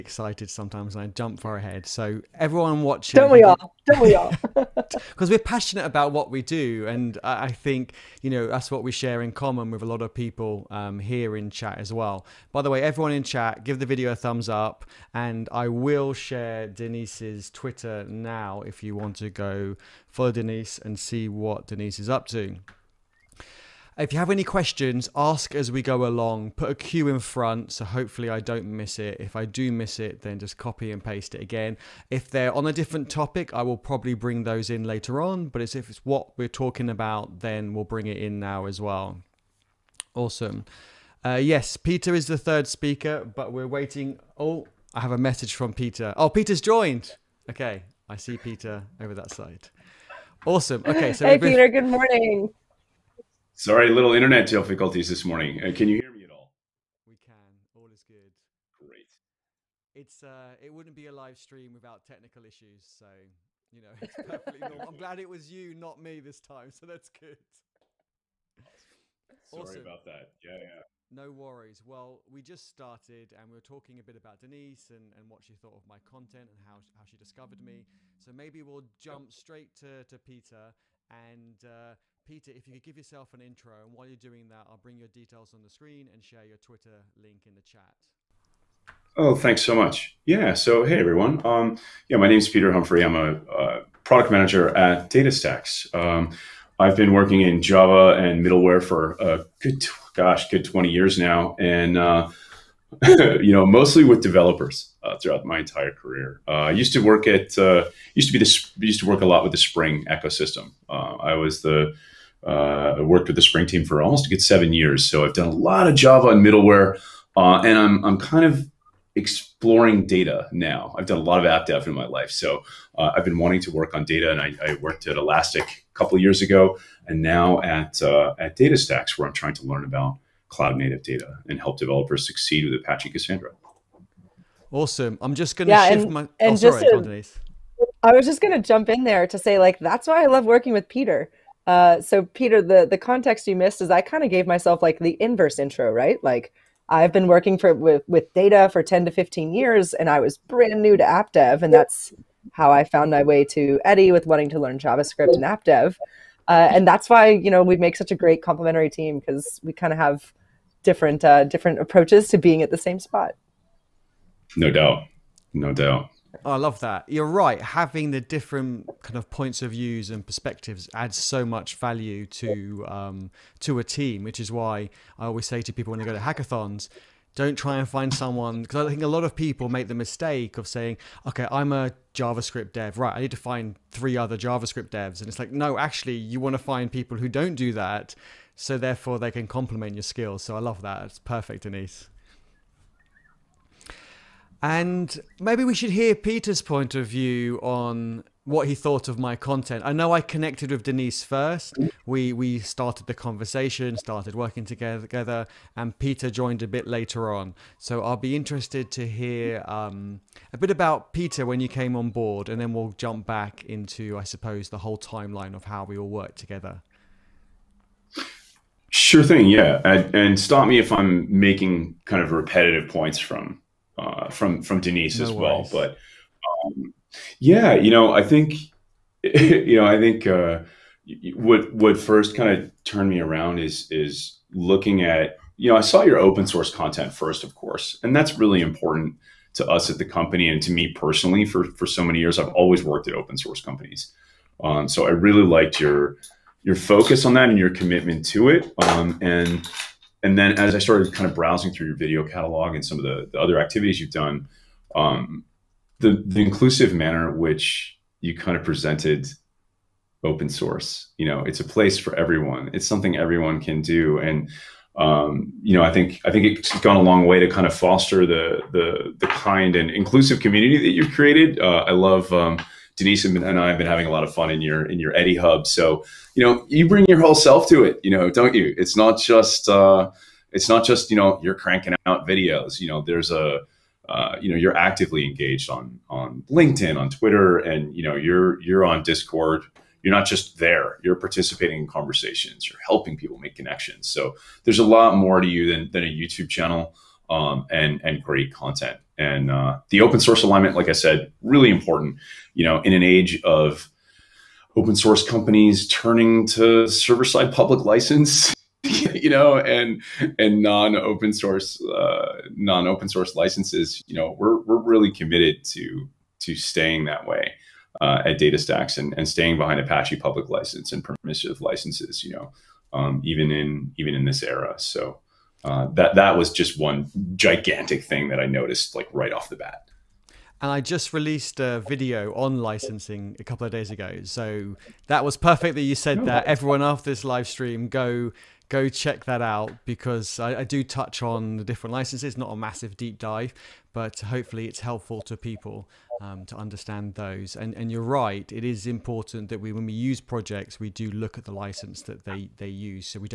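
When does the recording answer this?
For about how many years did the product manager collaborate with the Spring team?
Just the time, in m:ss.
1:54.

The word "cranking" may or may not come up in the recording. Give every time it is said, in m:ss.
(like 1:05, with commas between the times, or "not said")
4:41.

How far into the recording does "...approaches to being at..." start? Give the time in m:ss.
2:41.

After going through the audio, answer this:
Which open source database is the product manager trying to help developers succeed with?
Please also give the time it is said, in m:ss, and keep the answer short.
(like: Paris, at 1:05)
Apache Cassandra, at 2:12.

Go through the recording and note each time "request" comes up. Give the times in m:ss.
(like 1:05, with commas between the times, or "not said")
not said.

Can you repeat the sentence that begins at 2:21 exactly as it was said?
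Uh, so, Pieter, the the context you missed is I kind of gave myself like the inverse intro, right?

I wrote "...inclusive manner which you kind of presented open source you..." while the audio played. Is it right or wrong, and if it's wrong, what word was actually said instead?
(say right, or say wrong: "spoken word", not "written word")
right.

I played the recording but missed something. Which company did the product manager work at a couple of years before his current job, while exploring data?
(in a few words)
Elastic.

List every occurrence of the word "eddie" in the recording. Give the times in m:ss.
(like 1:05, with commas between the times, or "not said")
2:33, 4:35.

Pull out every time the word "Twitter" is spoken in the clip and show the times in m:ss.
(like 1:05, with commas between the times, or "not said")
0:17, 1:26, 4:47.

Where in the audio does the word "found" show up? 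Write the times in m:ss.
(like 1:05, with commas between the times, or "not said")
2:32.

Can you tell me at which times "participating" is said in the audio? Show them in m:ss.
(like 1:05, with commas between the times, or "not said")
4:51.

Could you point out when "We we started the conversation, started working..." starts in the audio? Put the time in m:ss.
3:22.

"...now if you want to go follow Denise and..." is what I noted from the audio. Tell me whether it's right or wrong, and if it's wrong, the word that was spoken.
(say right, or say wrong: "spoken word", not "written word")
right.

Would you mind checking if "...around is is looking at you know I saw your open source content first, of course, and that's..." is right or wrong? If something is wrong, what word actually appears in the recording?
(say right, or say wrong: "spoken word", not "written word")
right.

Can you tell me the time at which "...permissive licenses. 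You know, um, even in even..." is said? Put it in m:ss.
5:21.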